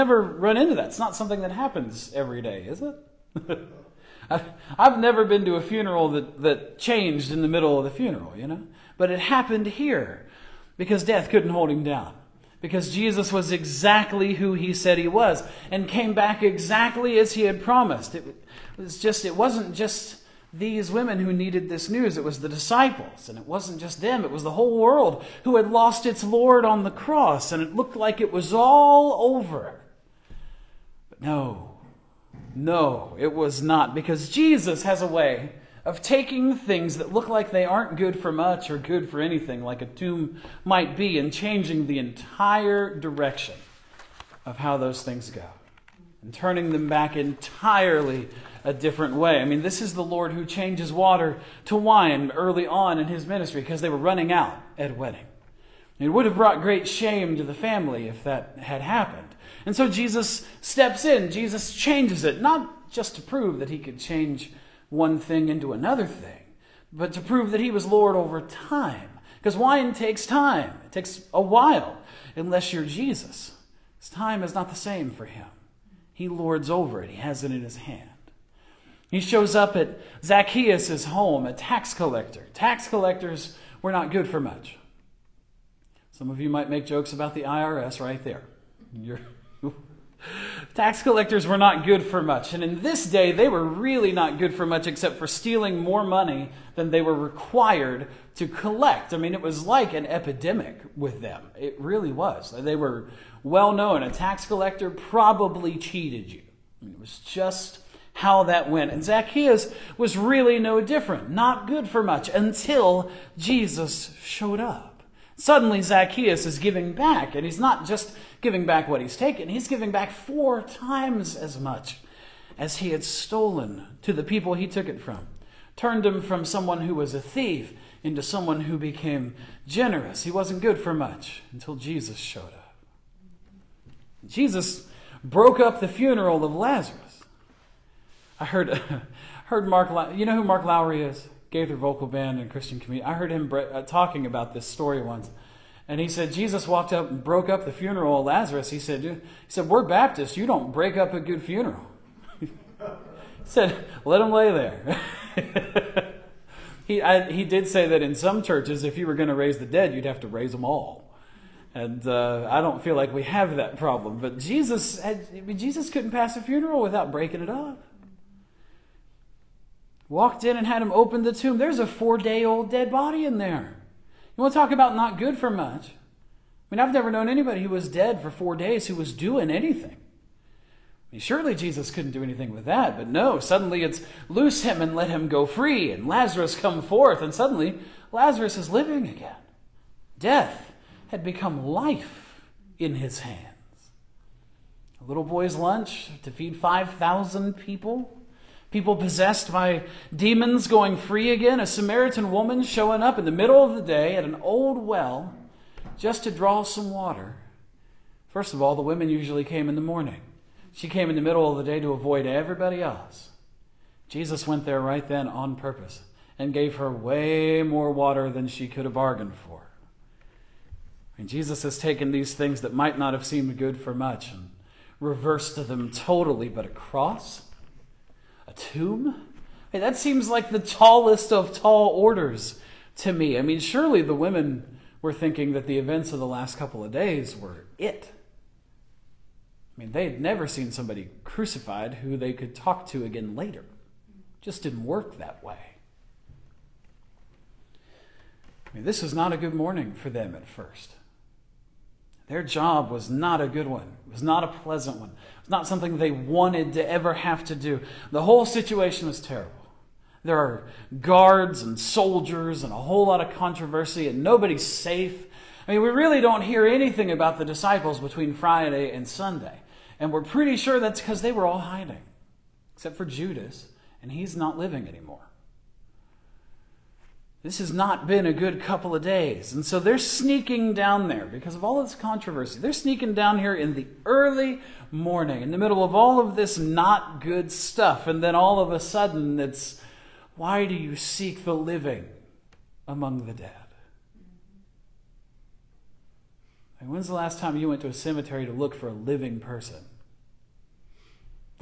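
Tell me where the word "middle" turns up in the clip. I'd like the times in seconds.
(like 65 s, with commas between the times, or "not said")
7 s, 203 s, 211 s, 285 s.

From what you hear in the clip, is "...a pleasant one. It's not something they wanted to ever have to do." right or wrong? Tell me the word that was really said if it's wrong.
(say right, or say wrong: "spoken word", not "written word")
right.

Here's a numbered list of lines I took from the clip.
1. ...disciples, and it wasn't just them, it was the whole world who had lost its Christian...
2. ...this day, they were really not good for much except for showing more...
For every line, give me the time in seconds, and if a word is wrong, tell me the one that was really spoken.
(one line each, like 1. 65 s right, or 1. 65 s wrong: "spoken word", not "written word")
1. 22 s wrong: "Lord", not "Christian"
2. 92 s wrong: "stealing", not "showing".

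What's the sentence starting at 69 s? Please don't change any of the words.
Because wine takes time, it takes a while, unless you're Jesus.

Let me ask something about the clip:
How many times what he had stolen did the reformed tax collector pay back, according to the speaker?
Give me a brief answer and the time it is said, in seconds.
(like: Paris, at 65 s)
4, at 120 s.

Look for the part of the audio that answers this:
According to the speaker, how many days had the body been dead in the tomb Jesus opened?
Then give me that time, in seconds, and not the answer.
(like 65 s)
171 s.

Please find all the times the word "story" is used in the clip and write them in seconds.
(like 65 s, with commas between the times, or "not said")
144 s.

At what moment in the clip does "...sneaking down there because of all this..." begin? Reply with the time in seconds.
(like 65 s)
279 s.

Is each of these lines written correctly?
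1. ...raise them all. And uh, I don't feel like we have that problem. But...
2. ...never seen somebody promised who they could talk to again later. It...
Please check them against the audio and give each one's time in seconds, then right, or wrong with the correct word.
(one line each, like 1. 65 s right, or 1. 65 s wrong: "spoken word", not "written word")
1. 160 s right
2. 240 s wrong: "crucified", not "promised".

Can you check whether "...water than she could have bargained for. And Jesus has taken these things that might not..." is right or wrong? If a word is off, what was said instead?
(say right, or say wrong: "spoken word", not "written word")
right.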